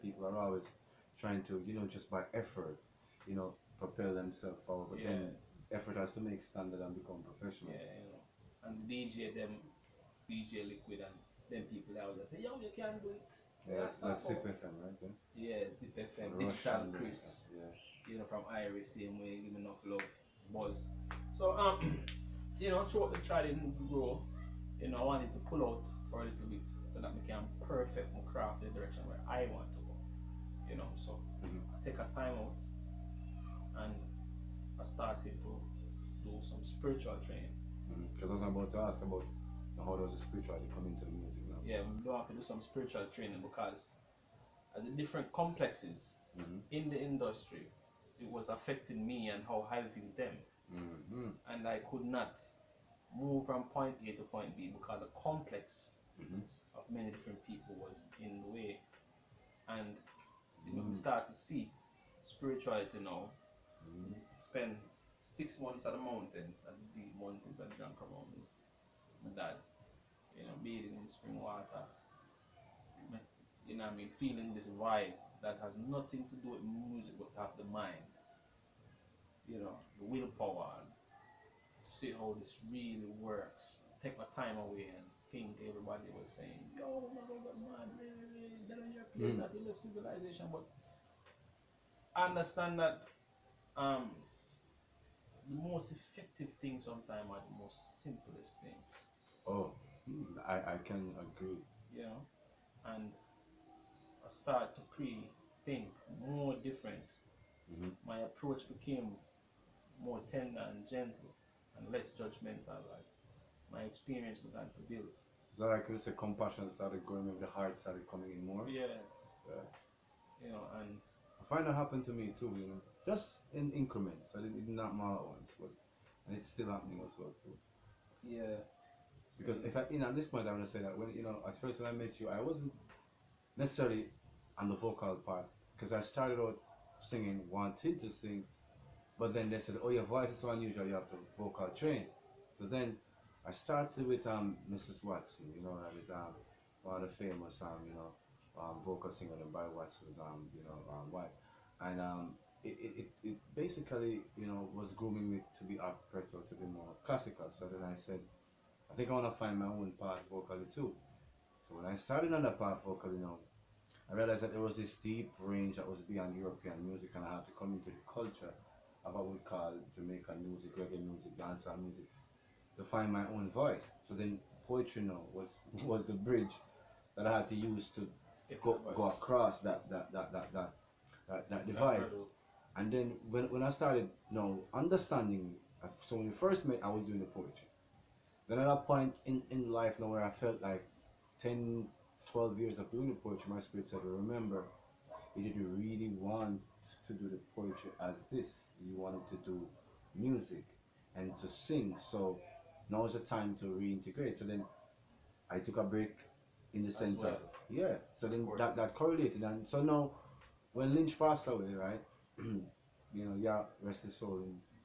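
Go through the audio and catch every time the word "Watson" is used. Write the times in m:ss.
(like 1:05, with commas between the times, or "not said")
2:25, 2:29.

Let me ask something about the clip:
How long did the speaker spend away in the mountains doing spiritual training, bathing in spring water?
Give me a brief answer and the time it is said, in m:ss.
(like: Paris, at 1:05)
6 months, at 1:05.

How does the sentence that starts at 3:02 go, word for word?
And then when, when I started you now understanding, uh, so when we first met, I was doing the poetry.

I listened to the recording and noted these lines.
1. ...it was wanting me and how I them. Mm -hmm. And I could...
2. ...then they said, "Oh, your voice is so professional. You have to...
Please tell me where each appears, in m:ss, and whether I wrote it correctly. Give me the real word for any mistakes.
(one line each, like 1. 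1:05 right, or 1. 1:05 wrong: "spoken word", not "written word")
1. 0:48 wrong: "affecting", not "wanting"
2. 2:19 wrong: "unusual", not "professional".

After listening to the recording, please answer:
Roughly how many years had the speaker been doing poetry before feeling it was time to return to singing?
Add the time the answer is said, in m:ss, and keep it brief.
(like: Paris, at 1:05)
10 to 12 years, at 3:11.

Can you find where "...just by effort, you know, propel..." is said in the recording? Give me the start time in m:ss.
0:01.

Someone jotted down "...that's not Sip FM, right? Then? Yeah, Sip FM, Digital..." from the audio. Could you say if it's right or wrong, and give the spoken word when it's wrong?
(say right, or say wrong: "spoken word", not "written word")
right.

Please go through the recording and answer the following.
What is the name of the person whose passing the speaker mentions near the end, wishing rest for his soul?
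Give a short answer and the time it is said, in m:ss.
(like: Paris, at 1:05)
Lynch, at 3:30.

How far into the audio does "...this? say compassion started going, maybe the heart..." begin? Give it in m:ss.
1:55.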